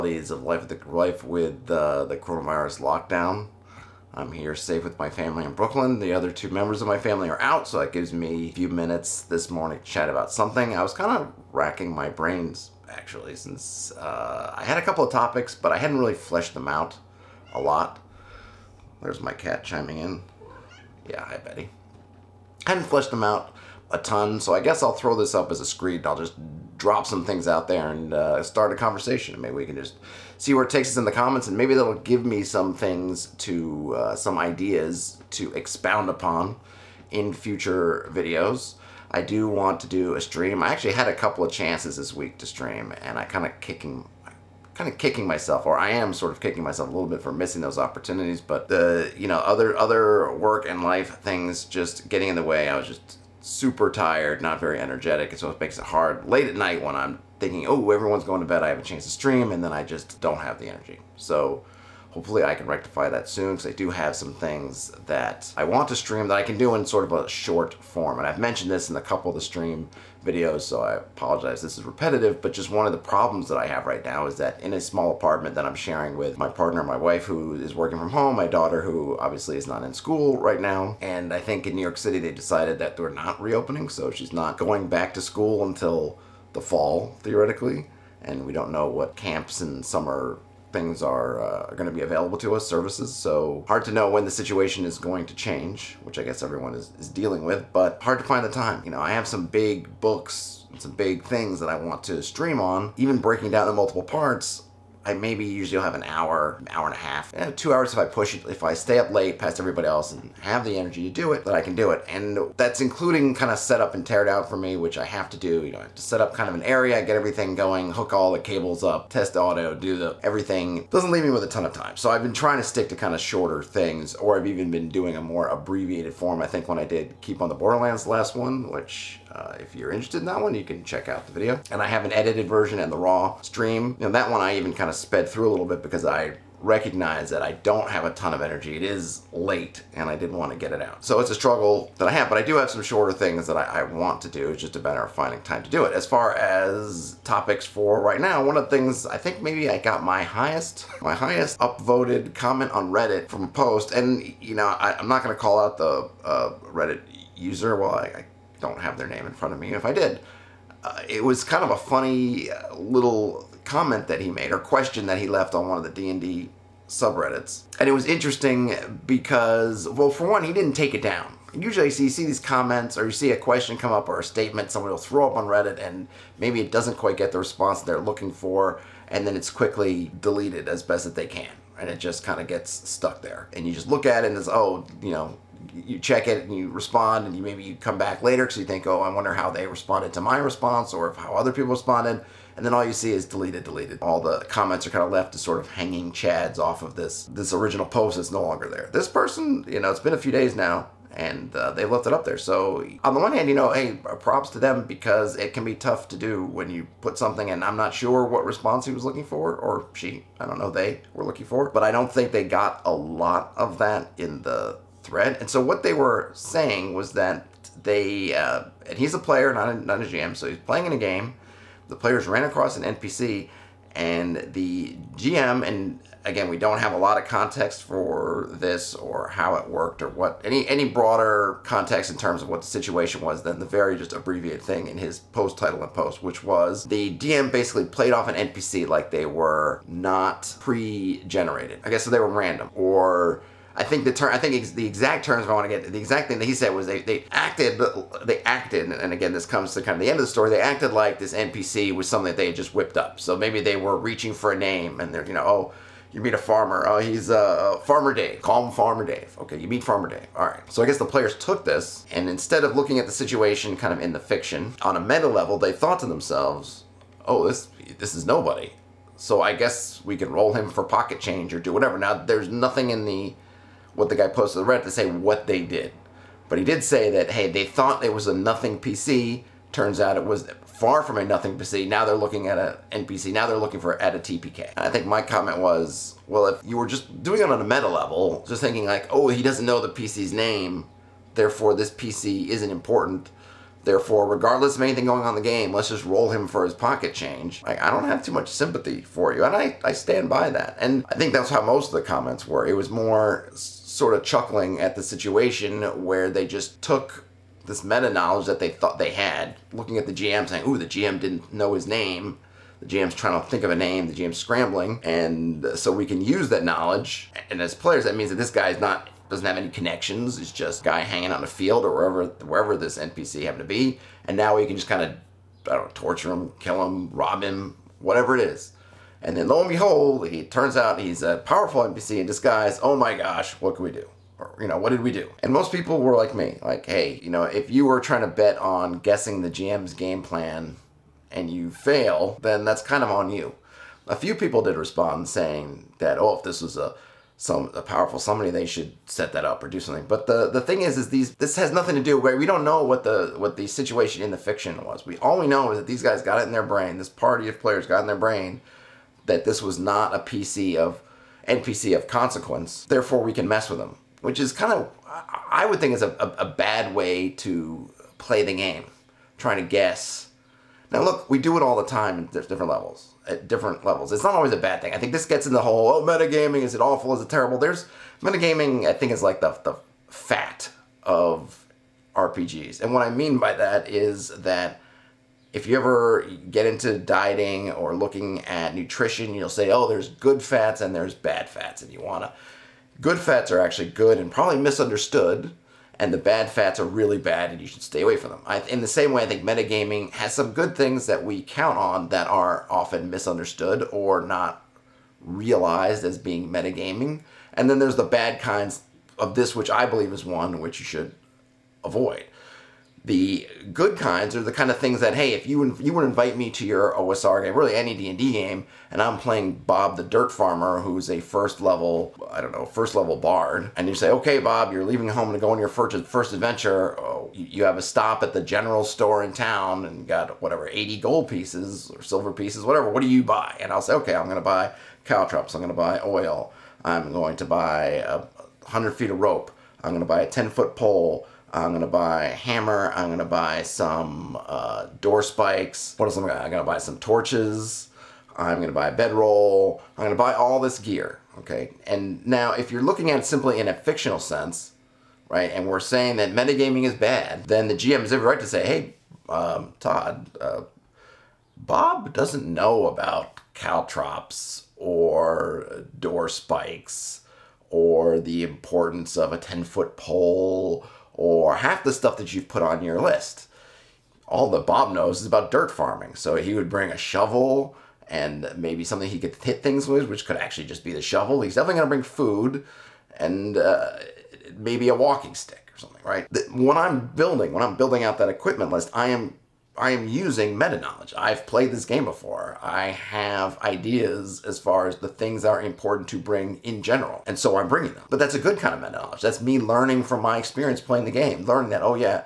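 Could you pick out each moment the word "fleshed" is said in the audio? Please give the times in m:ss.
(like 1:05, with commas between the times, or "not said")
0:16, 0:22.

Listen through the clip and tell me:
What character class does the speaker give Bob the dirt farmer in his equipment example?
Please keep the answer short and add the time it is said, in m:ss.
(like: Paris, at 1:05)
Bard, at 7:03.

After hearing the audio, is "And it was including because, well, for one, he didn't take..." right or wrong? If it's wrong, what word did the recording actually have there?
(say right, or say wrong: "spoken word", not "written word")
wrong: "interesting", not "including".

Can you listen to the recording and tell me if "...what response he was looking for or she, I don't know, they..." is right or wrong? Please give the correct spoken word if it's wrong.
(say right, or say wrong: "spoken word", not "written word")
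right.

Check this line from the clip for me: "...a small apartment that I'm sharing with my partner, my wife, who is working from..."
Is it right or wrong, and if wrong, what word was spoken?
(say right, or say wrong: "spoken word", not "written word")
right.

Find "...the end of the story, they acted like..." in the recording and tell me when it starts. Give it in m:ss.
4:09.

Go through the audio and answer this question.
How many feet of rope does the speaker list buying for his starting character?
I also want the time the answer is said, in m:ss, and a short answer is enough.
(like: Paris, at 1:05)
100, at 7:18.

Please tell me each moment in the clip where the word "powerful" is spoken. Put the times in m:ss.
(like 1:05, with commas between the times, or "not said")
5:31, 5:47.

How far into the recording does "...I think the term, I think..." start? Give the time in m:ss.
4:03.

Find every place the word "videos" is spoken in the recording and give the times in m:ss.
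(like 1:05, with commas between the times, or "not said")
0:38, 1:10, 2:11.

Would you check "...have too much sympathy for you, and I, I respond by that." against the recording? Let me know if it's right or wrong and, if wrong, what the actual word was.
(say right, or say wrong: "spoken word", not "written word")
wrong: "stand", not "respond".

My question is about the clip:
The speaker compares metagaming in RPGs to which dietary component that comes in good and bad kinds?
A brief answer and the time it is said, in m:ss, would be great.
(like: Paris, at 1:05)
Fat, at 6:20.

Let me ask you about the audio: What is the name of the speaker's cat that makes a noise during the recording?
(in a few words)
Betty.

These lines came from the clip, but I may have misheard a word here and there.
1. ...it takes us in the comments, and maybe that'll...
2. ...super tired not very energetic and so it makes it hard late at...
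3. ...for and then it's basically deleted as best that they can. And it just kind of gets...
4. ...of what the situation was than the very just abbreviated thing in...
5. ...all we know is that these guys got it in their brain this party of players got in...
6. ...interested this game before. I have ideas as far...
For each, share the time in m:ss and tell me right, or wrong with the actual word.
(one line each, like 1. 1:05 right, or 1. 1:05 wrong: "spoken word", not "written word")
1. 0:30 right
2. 0:53 right
3. 2:58 wrong: "quickly", not "basically"
4. 3:52 right
5. 5:55 right
6. 8:11 wrong: "played", not "interested".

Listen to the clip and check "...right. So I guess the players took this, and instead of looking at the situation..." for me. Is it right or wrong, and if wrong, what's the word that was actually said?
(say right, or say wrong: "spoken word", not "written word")
right.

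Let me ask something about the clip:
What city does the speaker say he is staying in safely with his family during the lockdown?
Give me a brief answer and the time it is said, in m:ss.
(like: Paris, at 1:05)
Brooklyn, at 0:05.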